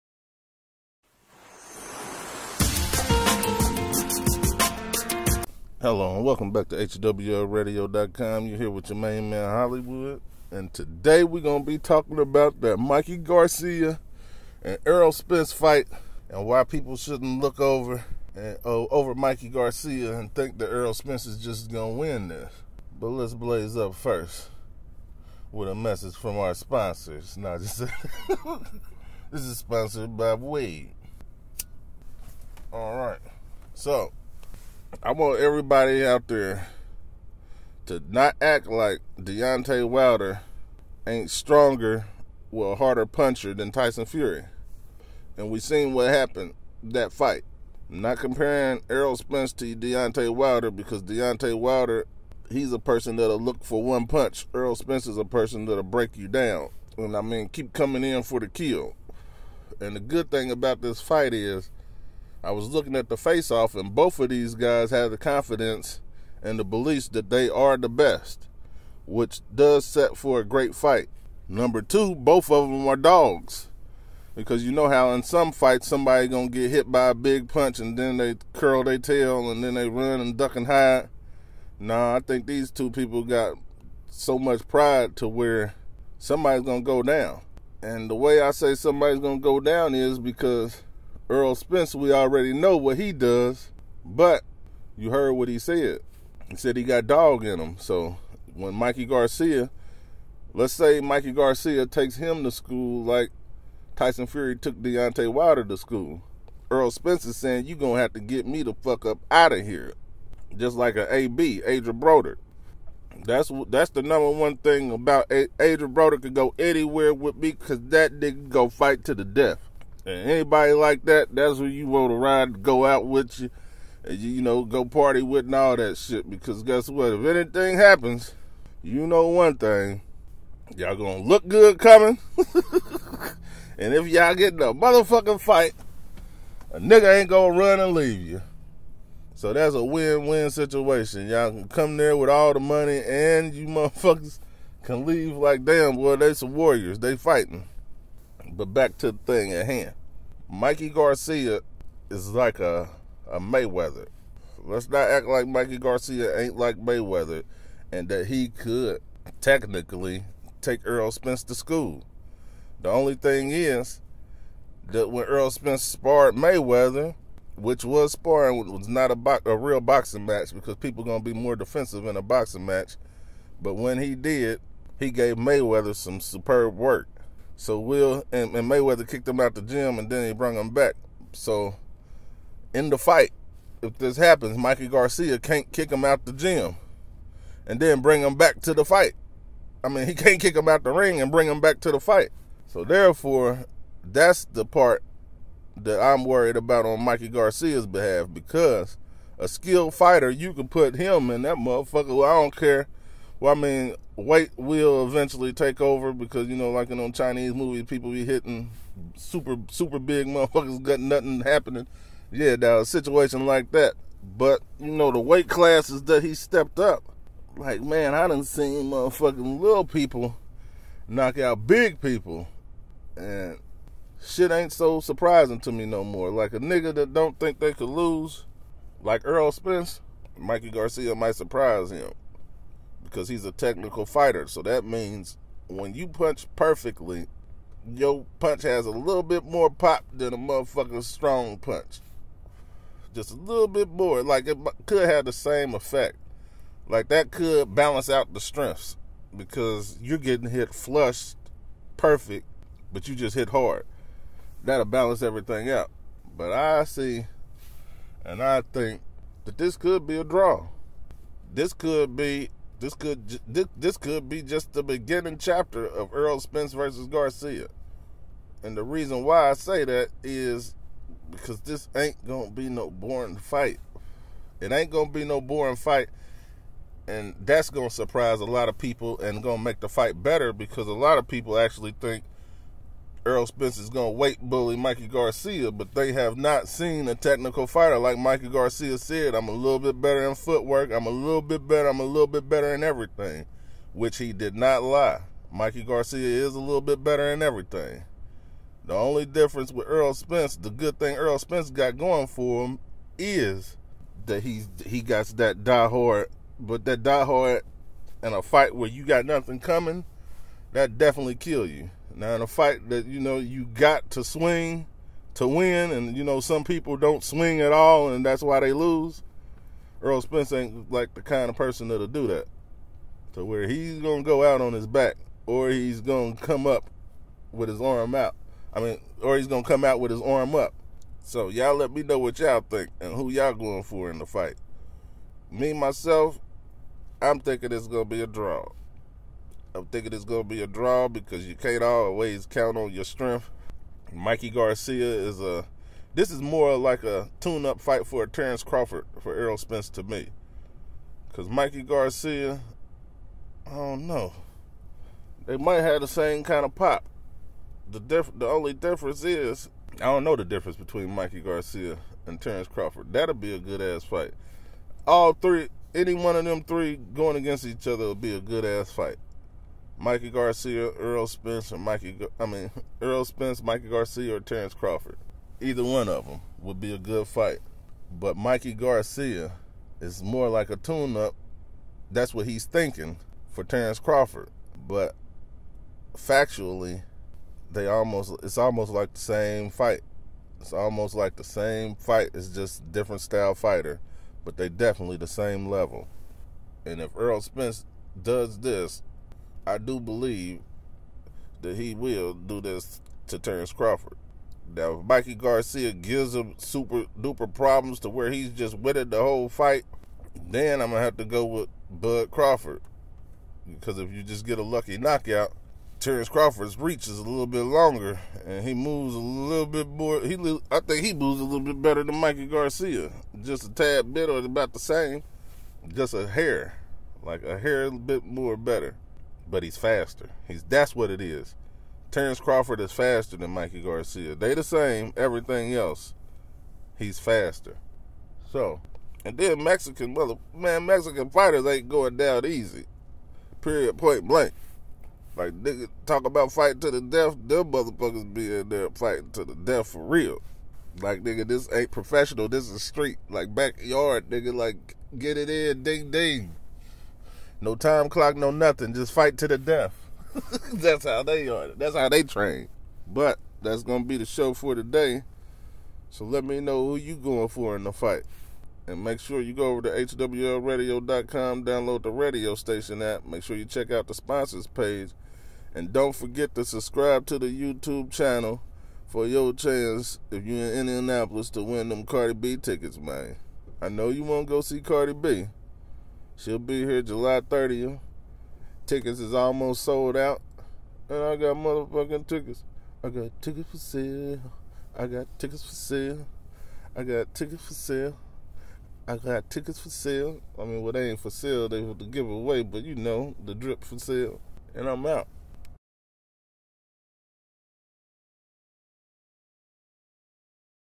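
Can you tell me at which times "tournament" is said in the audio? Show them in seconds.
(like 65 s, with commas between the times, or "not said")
not said.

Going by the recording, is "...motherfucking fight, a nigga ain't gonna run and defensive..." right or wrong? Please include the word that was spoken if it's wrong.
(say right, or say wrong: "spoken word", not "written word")
wrong: "leave", not "defensive".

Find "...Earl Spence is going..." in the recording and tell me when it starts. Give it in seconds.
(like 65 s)
283 s.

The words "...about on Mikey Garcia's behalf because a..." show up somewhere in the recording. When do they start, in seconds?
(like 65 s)
196 s.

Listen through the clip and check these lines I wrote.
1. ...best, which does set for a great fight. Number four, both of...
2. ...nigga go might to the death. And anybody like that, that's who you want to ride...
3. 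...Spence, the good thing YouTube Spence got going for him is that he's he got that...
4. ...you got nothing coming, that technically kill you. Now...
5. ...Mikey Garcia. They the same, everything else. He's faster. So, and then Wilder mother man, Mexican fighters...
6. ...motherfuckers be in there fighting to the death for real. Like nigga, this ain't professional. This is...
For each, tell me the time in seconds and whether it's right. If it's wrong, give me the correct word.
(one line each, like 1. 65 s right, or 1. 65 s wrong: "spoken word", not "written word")
1. 67 s wrong: "two", not "four"
2. 118 s wrong: "fight", not "might"
3. 300 s wrong: "Earl", not "YouTube"
4. 308 s wrong: "definitely", not "technically"
5. 433 s wrong: "Mexican", not "Wilder"
6. 447 s right.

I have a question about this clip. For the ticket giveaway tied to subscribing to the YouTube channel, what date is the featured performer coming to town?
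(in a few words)
July 30th.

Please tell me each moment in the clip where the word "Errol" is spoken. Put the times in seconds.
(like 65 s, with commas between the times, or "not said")
14 s, 20 s, 48 s, 54 s, 349 s.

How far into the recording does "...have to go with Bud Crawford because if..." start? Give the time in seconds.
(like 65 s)
411 s.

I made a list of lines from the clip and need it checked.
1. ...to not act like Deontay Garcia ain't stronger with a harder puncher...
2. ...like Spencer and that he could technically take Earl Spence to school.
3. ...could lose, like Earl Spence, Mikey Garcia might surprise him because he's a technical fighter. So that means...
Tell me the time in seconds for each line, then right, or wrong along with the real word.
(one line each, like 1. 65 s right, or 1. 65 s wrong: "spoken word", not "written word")
1. 37 s wrong: "Wilder", not "Garcia"
2. 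156 s wrong: "Mayweather", not "Spencer"
3. 227 s right.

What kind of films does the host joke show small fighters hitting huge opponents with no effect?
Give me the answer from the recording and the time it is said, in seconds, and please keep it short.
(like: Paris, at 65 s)
Chinese movies, at 207 s.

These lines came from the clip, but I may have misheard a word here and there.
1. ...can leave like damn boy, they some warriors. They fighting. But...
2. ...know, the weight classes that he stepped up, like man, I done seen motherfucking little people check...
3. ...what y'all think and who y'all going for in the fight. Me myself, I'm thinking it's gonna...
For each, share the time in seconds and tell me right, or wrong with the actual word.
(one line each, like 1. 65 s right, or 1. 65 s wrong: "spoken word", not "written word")
1. 144 s right
2. 214 s wrong: "knock", not "check"
3. 332 s right.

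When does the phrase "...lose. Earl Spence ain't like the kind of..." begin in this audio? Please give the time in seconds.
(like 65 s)
318 s.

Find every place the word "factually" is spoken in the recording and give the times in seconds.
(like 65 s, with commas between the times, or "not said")
386 s.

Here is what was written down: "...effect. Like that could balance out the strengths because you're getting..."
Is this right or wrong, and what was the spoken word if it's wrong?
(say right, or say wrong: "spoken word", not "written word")
right.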